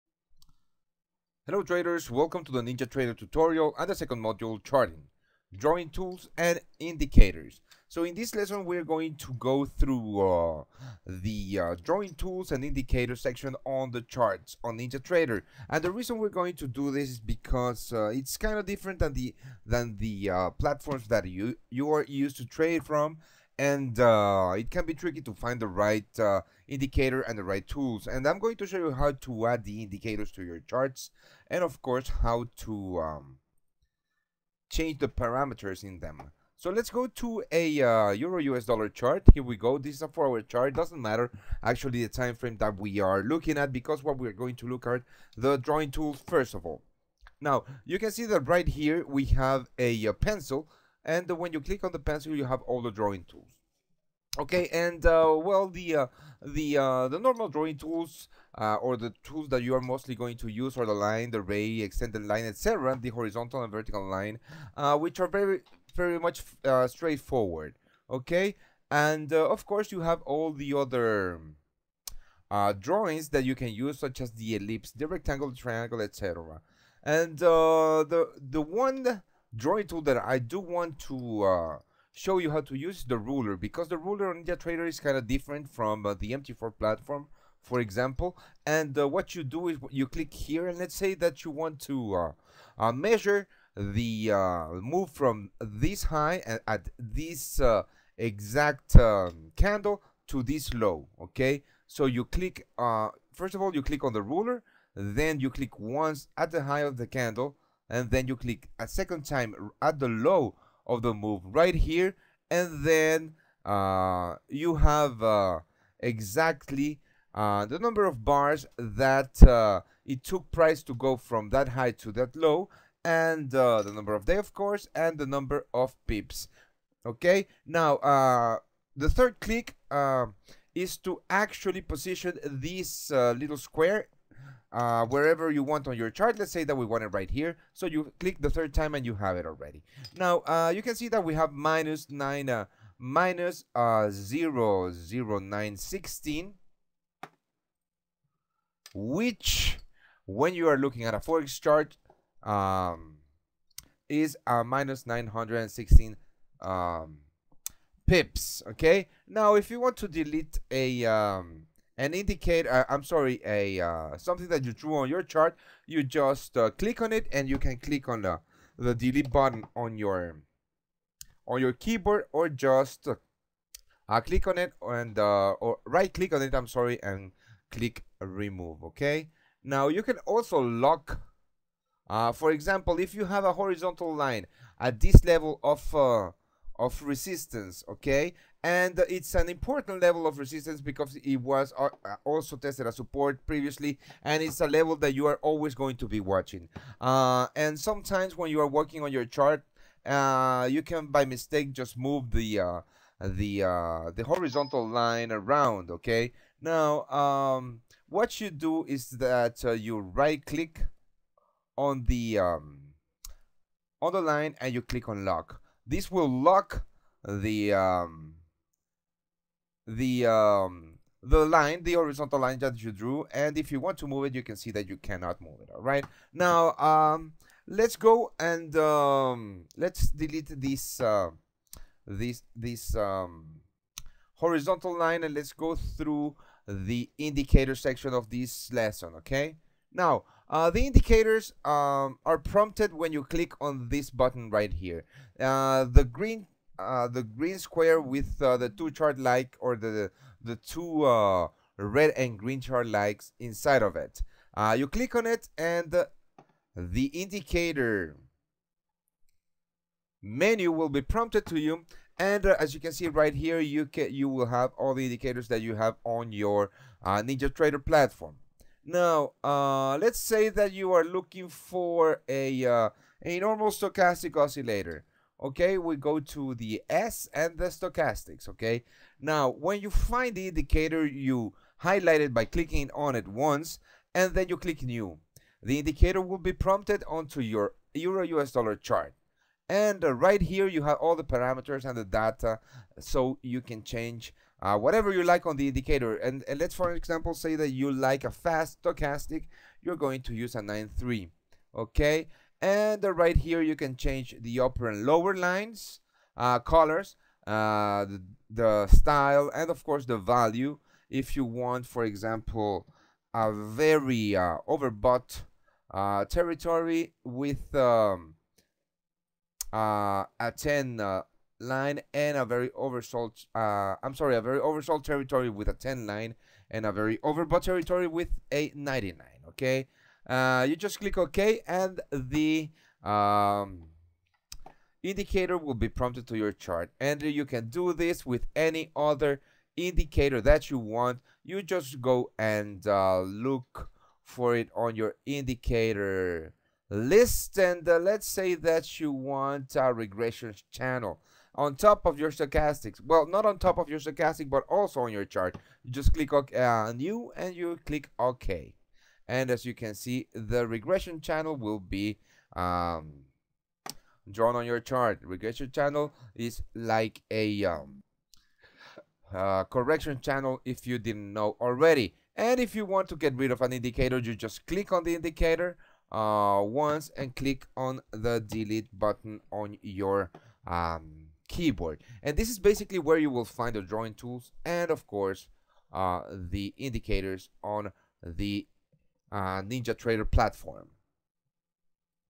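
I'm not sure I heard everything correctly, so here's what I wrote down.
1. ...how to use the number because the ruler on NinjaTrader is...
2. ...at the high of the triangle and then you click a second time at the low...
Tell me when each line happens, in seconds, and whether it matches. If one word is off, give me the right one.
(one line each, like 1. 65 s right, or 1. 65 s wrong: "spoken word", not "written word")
1. 82 s wrong: "ruler", not "number"
2. 106 s wrong: "candle", not "triangle".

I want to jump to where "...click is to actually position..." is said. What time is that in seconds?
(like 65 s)
129 s.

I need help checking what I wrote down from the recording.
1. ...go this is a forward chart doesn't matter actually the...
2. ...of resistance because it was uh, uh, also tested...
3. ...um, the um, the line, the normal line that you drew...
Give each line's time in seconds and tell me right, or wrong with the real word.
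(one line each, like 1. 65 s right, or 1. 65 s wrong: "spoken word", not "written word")
1. 39 s right
2. 190 s right
3. 217 s wrong: "horizontal", not "normal".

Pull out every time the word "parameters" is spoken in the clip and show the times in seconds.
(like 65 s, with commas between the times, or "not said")
35 s, 291 s.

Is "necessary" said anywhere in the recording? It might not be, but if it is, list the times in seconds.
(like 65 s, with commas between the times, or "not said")
not said.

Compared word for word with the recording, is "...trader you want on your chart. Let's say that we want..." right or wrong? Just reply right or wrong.
wrong.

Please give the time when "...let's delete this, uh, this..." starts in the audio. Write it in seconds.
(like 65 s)
229 s.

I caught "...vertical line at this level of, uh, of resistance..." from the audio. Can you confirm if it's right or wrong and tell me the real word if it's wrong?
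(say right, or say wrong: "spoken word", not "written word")
wrong: "horizontal", not "vertical".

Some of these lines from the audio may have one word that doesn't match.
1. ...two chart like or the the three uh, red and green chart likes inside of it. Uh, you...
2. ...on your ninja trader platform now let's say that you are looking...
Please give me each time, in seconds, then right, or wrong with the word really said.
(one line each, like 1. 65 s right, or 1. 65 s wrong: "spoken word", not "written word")
1. 248 s wrong: "two", not "three"
2. 266 s right.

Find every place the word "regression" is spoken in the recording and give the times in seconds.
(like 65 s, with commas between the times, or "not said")
349 s, 360 s, 365 s.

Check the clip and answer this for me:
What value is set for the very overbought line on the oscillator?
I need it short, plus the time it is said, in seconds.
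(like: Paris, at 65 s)
99, at 328 s.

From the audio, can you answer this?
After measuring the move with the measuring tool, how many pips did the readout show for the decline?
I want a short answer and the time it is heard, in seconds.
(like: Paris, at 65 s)
-916, at 154 s.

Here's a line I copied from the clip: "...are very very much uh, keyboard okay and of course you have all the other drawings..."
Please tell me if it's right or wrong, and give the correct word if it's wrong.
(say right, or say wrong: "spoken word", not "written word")
wrong: "straightforward", not "keyboard".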